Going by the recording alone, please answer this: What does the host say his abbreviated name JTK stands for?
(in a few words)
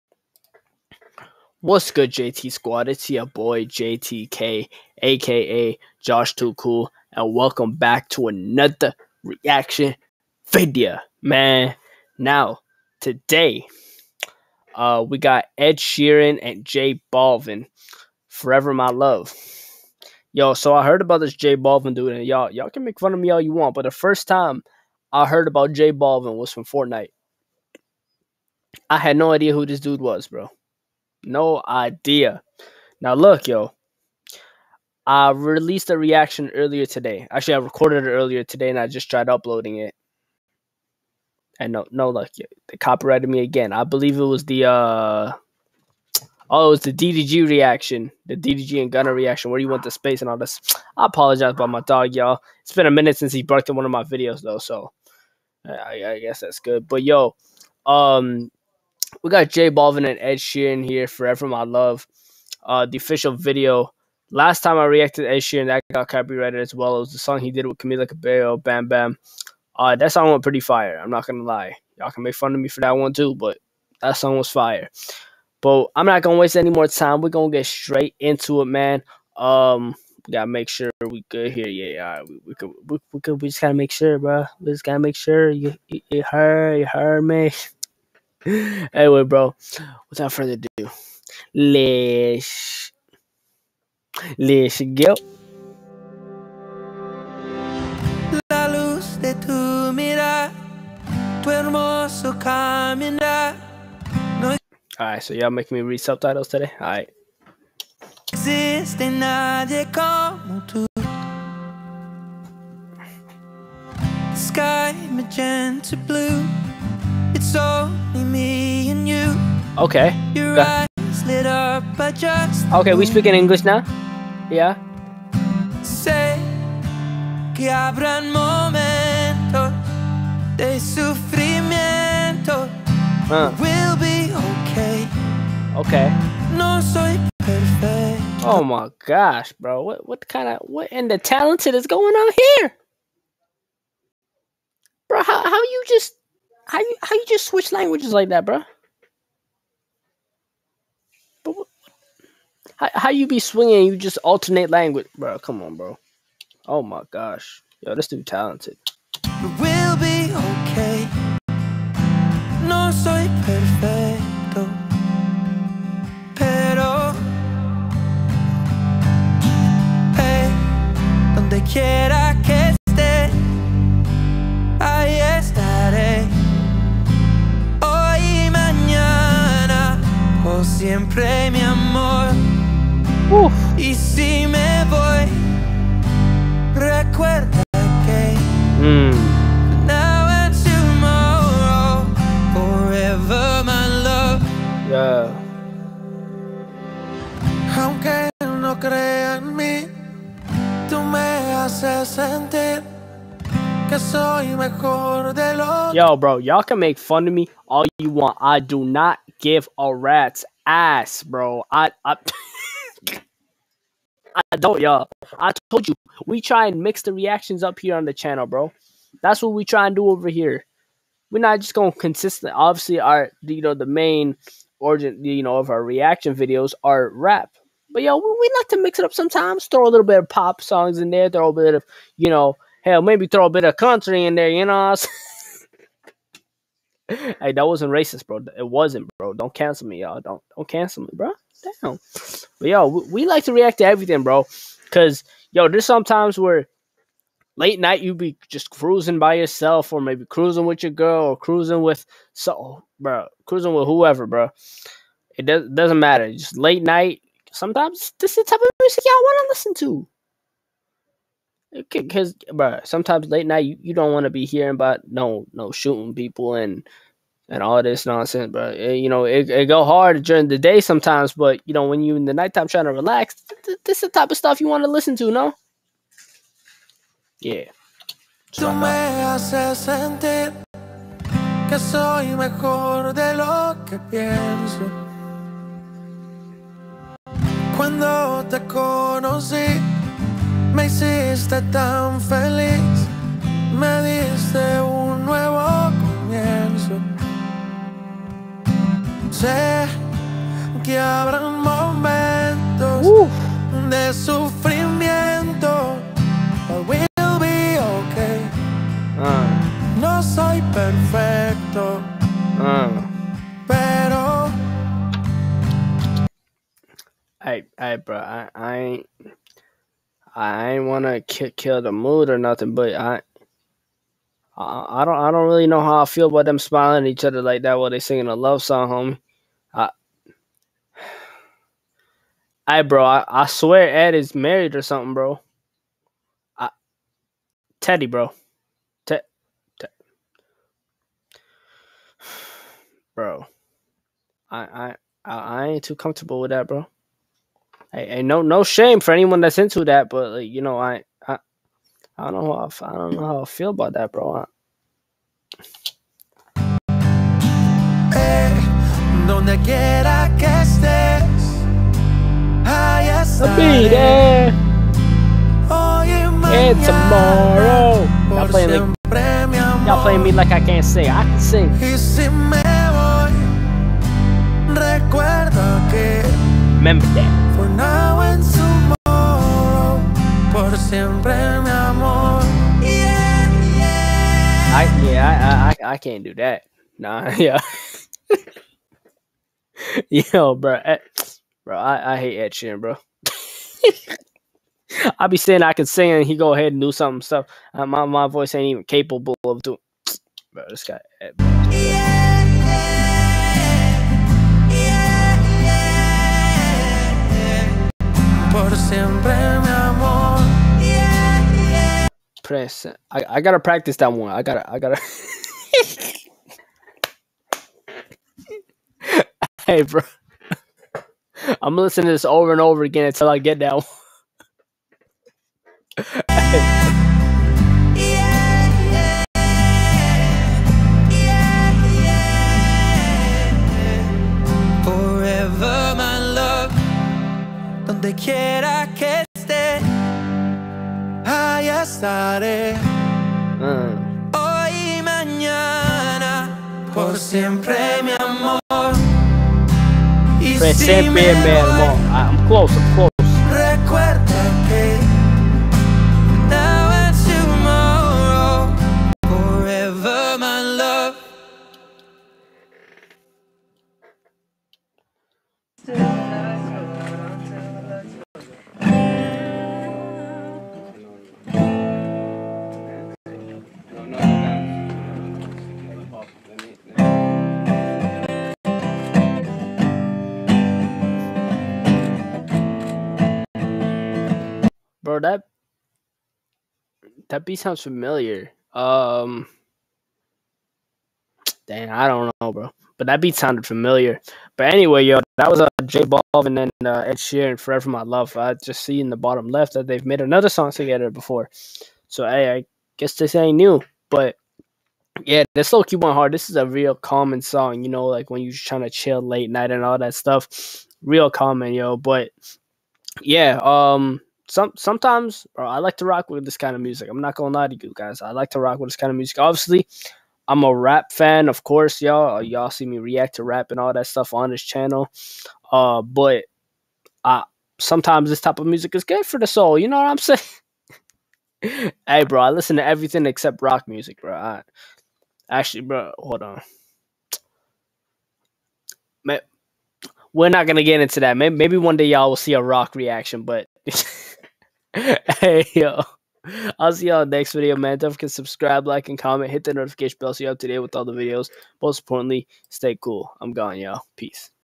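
Josh Too Cool.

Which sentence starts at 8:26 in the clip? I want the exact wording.
This is a real common song, you know, like when you're trying to chill late night and all that stuff.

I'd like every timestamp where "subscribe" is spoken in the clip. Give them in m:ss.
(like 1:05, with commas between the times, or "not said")
9:08.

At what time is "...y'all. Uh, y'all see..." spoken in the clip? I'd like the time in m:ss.
8:42.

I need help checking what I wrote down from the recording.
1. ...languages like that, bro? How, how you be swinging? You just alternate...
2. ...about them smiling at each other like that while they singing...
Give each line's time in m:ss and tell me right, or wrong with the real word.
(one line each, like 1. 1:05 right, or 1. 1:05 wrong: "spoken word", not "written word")
1. 2:27 right
2. 5:26 right.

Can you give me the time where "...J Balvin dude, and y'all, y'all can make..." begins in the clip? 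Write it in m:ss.
0:21.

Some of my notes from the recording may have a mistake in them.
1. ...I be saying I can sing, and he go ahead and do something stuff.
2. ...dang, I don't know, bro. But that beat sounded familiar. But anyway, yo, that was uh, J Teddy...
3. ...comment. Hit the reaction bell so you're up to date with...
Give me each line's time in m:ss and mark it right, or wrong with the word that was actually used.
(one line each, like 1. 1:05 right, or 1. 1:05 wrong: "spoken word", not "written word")
1. 6:35 right
2. 8:11 wrong: "Balvin", not "Teddy"
3. 9:09 wrong: "notification", not "reaction".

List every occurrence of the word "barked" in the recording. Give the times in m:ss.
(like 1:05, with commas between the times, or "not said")
0:53.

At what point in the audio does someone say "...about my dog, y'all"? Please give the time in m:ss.
0:51.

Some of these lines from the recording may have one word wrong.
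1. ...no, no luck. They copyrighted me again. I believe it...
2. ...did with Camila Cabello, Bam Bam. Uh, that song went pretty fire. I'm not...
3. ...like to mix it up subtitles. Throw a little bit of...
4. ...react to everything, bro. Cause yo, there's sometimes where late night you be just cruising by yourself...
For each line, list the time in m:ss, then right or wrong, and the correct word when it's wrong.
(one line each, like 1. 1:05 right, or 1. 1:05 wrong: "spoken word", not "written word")
1. 0:41 right
2. 1:07 right
3. 3:48 wrong: "sometimes", not "subtitles"
4. 4:03 right.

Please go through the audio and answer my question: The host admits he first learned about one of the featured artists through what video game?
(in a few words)
Fortnite.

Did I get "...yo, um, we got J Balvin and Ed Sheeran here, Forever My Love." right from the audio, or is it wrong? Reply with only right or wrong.
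right.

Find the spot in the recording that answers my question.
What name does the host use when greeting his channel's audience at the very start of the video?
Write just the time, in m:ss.
0:02.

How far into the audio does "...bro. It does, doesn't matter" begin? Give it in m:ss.
4:14.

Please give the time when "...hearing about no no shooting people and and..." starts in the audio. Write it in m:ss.
4:24.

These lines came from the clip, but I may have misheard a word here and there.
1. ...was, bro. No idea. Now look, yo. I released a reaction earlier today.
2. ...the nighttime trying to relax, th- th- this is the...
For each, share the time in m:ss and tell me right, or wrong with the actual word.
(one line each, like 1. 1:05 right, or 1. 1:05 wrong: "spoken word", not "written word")
1. 0:30 right
2. 4:32 right.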